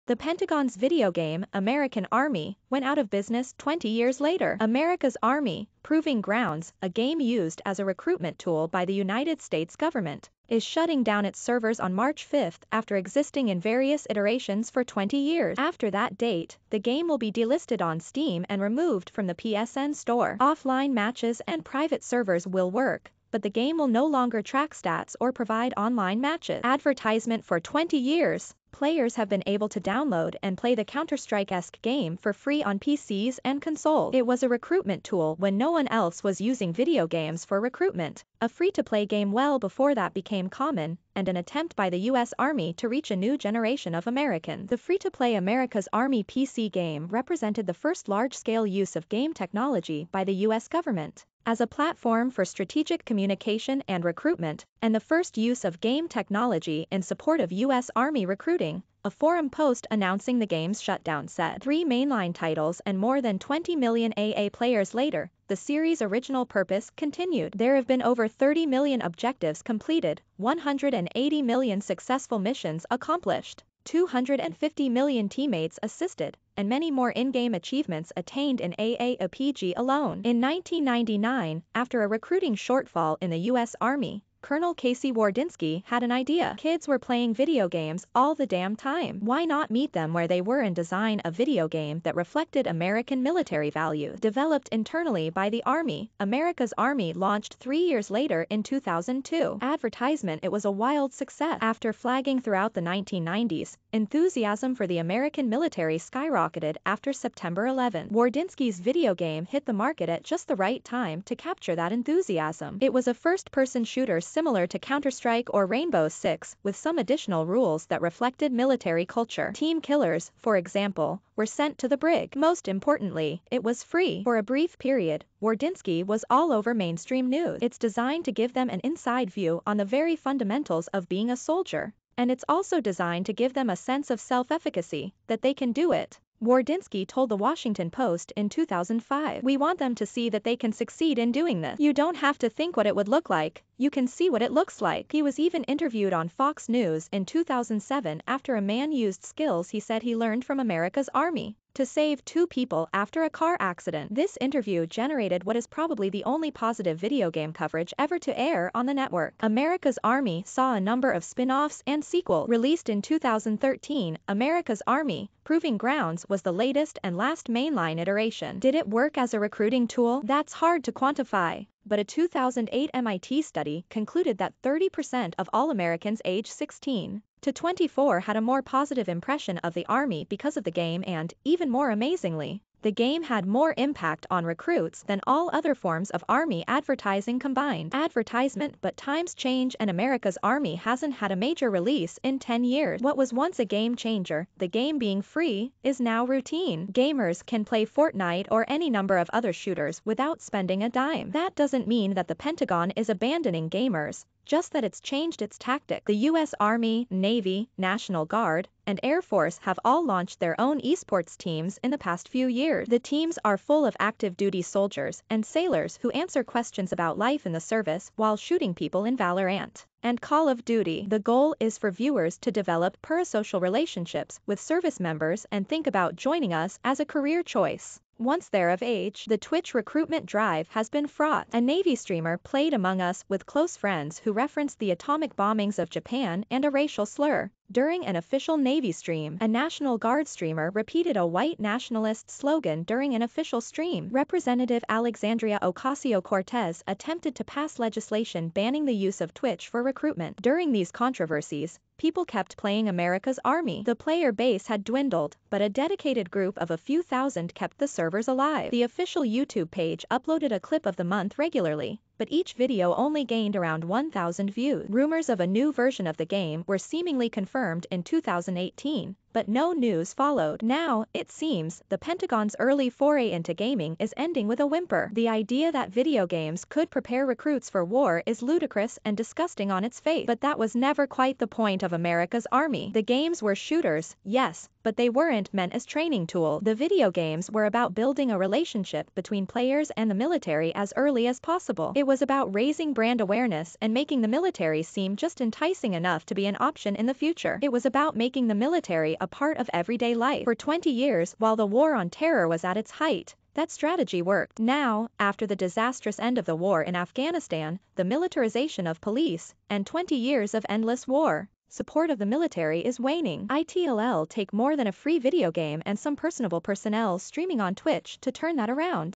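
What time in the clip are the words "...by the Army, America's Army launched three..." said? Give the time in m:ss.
1:35.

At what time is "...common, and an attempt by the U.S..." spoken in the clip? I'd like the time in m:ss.
0:40.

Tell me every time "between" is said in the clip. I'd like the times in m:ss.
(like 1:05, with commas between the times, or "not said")
4:49.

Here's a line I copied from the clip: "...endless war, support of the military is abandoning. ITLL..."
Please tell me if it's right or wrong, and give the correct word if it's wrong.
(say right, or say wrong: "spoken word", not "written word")
wrong: "waning", not "abandoning".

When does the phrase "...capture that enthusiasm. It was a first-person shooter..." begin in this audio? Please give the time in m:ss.
1:51.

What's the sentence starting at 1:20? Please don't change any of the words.
In 1999, after a recruiting shortfall in the U.S.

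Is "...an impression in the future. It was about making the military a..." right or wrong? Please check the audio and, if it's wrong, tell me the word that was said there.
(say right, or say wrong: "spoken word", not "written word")
wrong: "option", not "impression".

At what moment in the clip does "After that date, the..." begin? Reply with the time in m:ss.
0:15.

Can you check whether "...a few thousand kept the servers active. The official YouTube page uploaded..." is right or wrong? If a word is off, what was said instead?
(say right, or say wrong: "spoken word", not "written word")
wrong: "alive", not "active".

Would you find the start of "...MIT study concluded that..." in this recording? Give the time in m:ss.
2:52.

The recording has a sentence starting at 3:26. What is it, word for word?
Army, Navy, National Guard, and Air Force have all launched their own esports teams in the past few years.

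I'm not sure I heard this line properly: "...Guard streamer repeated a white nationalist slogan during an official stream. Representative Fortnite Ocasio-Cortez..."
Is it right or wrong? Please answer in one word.
wrong.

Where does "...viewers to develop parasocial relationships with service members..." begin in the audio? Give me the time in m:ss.
3:41.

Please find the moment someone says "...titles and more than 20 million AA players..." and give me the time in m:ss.
1:02.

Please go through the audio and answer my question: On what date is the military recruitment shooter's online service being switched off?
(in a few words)
March 5.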